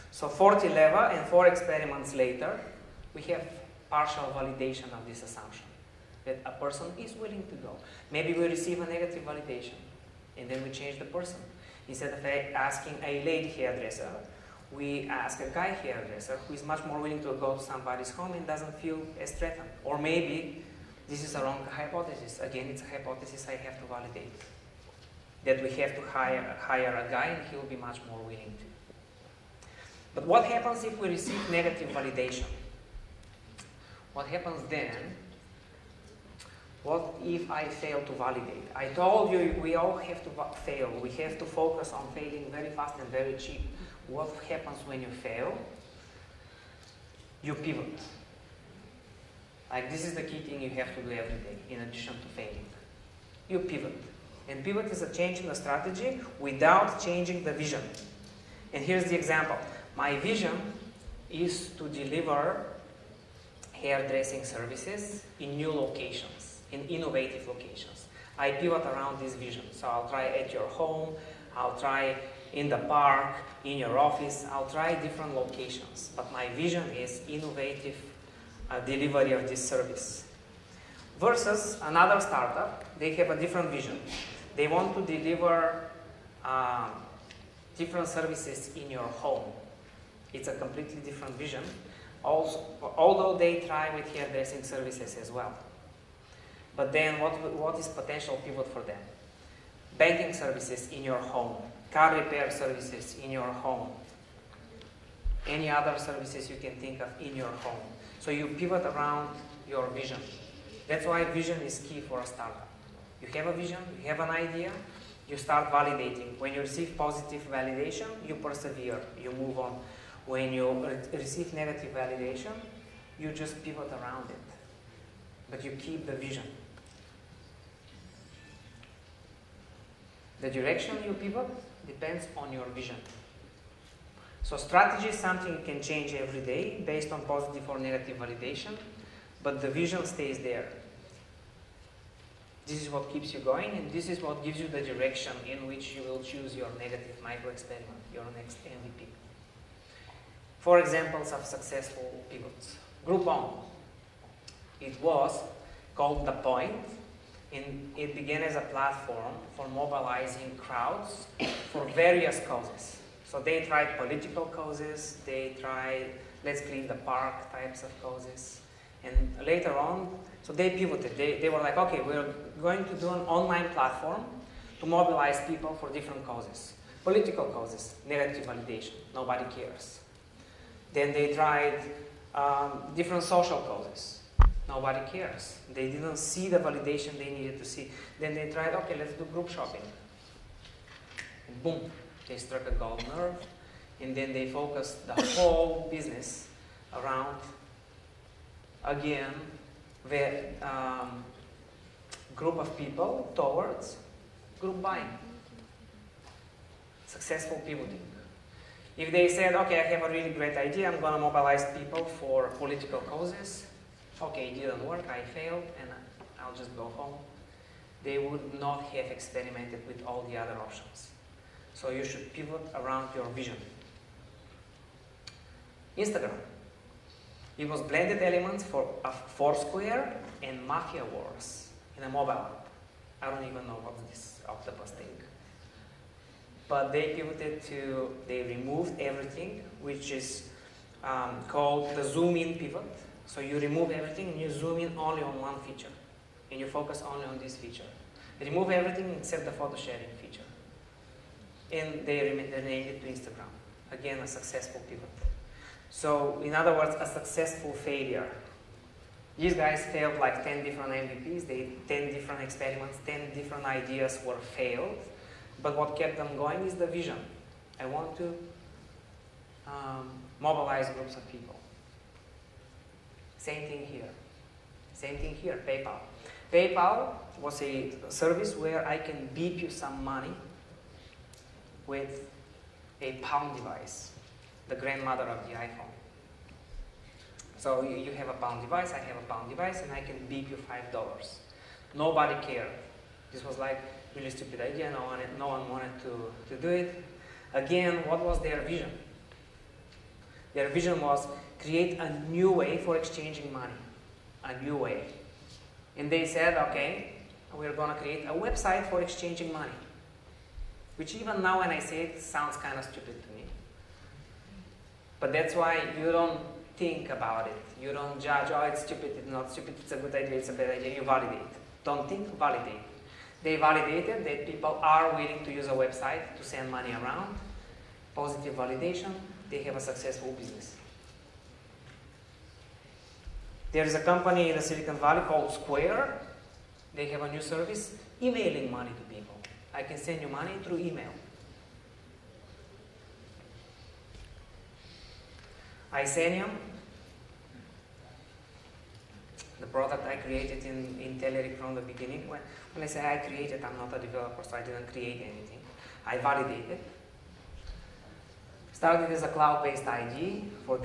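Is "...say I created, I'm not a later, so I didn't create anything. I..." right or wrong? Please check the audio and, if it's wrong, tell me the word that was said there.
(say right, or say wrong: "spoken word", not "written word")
wrong: "developer", not "later".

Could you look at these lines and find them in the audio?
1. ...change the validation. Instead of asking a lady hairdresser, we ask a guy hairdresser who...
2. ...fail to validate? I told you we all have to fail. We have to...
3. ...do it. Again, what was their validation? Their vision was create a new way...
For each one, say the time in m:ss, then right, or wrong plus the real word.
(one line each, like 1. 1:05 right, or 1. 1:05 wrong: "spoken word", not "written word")
1. 0:10 wrong: "person", not "validation"
2. 0:37 right
3. 4:56 wrong: "vision", not "validation".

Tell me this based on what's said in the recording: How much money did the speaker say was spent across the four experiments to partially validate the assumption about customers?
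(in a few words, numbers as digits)
40 leva.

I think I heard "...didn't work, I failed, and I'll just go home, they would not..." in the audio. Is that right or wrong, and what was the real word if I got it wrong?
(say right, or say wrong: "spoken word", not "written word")
right.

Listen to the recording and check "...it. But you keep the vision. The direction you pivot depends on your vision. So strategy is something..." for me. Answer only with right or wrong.
right.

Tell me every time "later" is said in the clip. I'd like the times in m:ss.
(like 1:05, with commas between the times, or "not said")
0:02, 2:49.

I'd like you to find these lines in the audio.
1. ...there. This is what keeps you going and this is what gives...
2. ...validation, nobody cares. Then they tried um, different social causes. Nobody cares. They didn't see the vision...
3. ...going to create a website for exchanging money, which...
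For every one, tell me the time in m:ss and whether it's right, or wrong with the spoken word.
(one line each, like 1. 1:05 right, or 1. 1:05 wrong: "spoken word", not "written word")
1. 2:20 right
2. 2:58 wrong: "validation", not "vision"
3. 5:07 right.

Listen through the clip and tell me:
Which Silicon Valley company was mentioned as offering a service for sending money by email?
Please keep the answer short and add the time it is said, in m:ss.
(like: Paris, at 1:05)
Square, at 5:35.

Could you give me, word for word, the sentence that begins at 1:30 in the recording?
It's a completely different vision, also, although they try with hairdressing services as well.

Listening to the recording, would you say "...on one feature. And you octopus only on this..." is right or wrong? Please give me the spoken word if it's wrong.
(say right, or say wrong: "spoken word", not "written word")
wrong: "focus", not "octopus".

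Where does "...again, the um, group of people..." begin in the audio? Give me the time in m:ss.
3:18.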